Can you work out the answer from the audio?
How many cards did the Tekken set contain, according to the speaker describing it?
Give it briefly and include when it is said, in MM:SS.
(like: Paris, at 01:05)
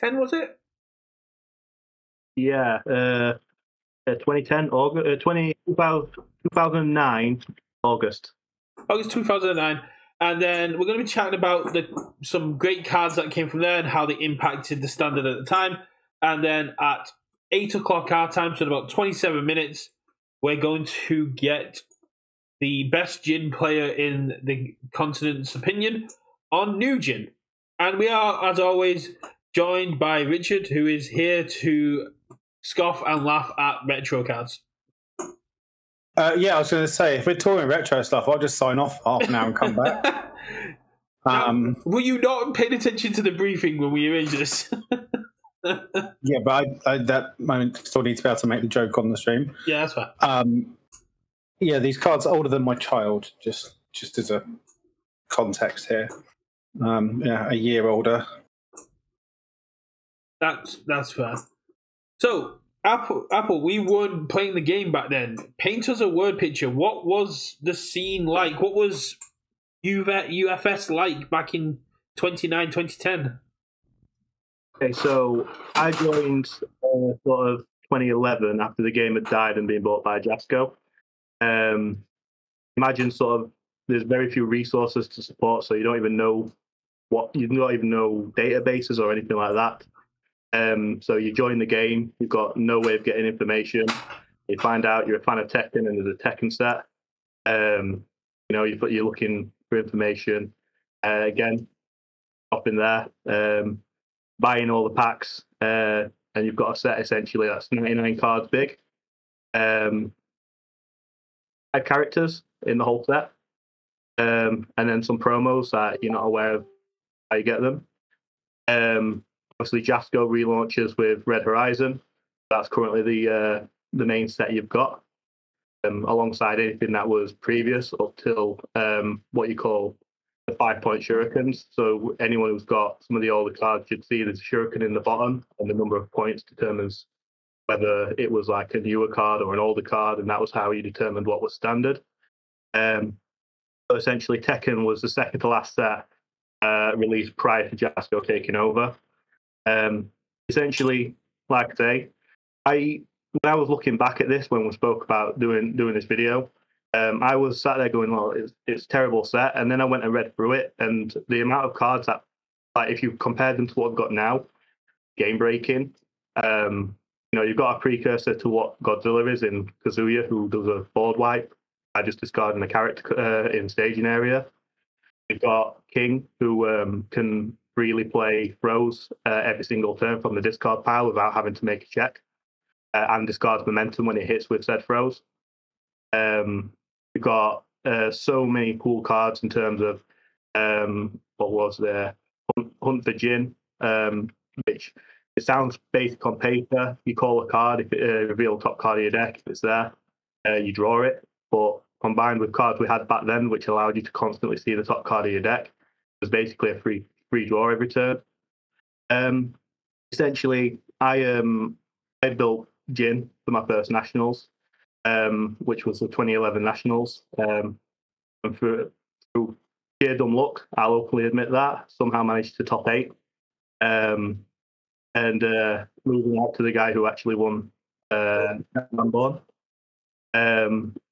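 99, at 01:47.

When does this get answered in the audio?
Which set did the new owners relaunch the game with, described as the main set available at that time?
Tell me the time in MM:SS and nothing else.
02:01.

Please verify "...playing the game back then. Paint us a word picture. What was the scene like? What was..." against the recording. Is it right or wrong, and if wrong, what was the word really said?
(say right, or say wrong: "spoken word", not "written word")
right.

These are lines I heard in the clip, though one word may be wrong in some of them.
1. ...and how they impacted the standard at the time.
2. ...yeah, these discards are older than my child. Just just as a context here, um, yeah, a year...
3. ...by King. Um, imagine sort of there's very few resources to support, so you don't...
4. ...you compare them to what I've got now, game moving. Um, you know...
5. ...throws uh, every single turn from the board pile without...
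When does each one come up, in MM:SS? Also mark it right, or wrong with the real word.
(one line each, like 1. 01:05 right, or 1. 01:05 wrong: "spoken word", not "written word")
1. 00:13 right
2. 00:51 wrong: "cards", not "discards"
3. 01:20 wrong: "Jasco", not "King"
4. 02:43 wrong: "breaking", not "moving"
5. 02:58 wrong: "discard", not "board".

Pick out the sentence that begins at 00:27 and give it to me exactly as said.
And we are, as always, joined by Richard, who is here to scoff and laugh at retro cards.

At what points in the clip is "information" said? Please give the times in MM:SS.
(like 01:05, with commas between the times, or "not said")
01:33, 01:39.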